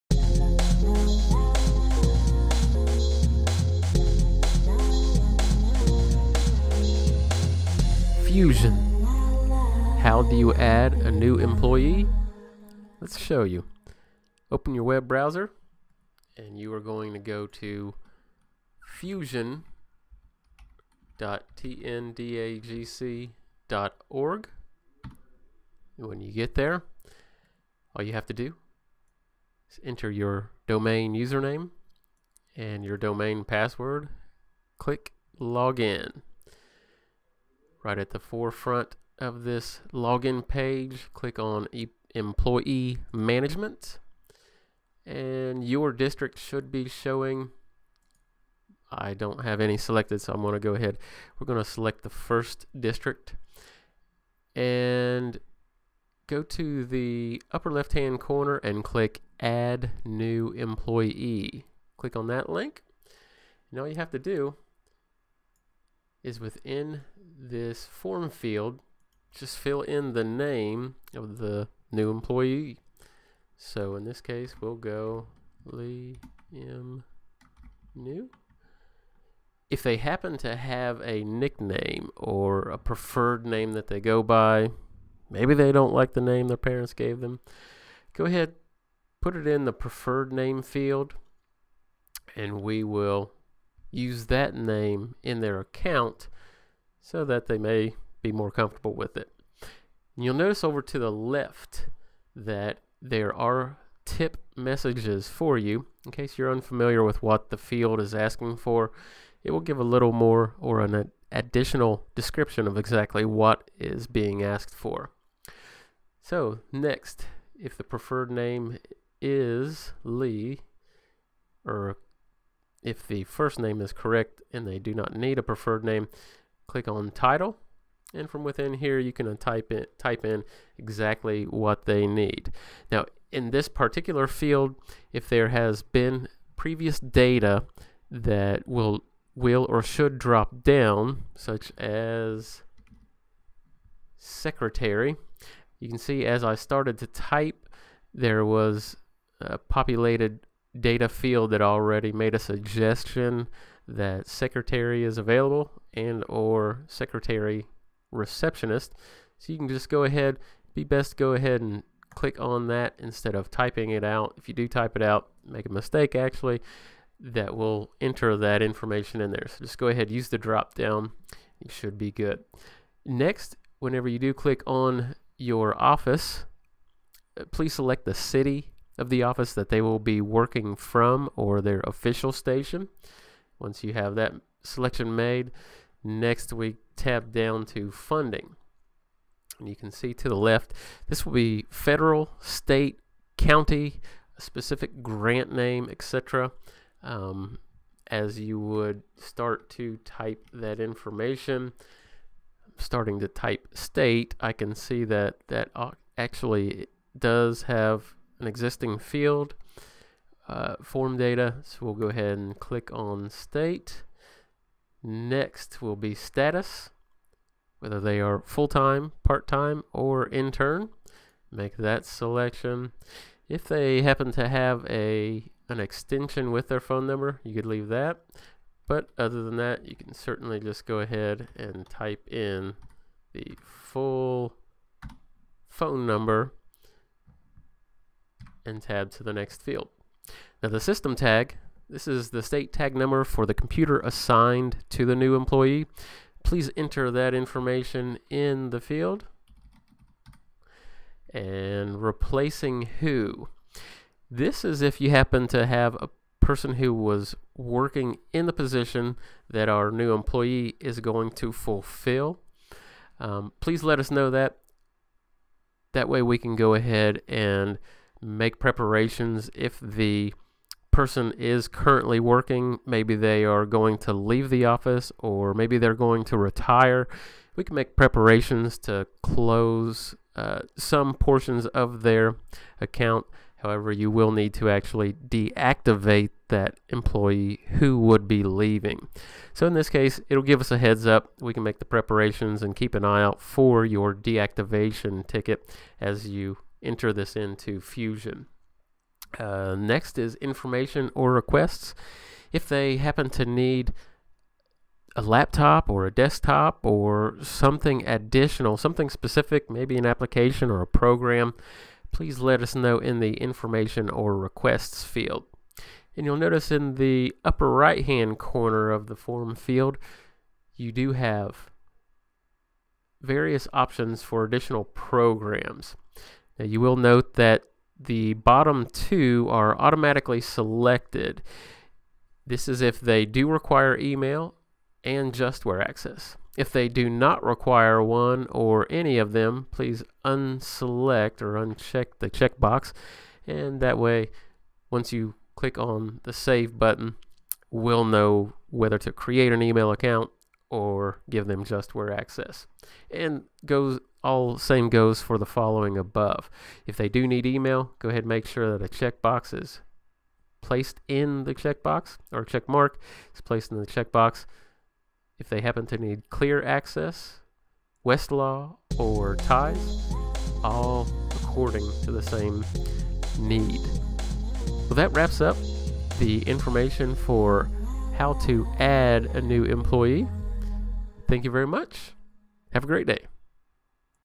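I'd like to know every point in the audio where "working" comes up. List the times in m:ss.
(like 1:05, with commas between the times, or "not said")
3:00, 4:17, 4:32.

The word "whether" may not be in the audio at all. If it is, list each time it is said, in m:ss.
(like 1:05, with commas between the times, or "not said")
3:37, 5:48.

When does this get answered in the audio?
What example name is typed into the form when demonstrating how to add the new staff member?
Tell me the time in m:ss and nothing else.
1:15.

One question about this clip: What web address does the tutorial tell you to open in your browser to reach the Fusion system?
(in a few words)
fusion.tndagc.org.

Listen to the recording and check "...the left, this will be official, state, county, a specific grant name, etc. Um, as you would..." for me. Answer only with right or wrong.
wrong.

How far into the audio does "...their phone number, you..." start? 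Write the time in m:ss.
3:46.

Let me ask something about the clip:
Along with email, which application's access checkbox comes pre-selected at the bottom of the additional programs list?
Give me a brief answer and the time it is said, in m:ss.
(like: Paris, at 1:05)
JustWare, at 5:35.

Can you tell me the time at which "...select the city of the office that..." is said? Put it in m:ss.
2:57.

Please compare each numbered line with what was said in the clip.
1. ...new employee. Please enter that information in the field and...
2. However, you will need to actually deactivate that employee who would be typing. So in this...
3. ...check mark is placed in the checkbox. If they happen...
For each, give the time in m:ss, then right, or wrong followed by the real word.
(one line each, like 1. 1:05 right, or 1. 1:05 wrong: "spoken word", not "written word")
1. 4:05 right
2. 4:43 wrong: "leaving", not "typing"
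3. 6:02 right.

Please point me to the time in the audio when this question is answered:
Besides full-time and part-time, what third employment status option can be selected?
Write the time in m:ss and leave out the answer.
3:40.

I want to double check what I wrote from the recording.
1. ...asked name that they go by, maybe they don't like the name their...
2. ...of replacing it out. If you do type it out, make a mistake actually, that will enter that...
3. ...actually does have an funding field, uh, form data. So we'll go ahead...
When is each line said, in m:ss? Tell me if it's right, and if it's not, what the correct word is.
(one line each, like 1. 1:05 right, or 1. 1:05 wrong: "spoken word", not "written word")
1. 1:22 wrong: "preferred", not "asked"
2. 2:43 wrong: "typing", not "replacing"
3. 3:26 wrong: "existing", not "funding".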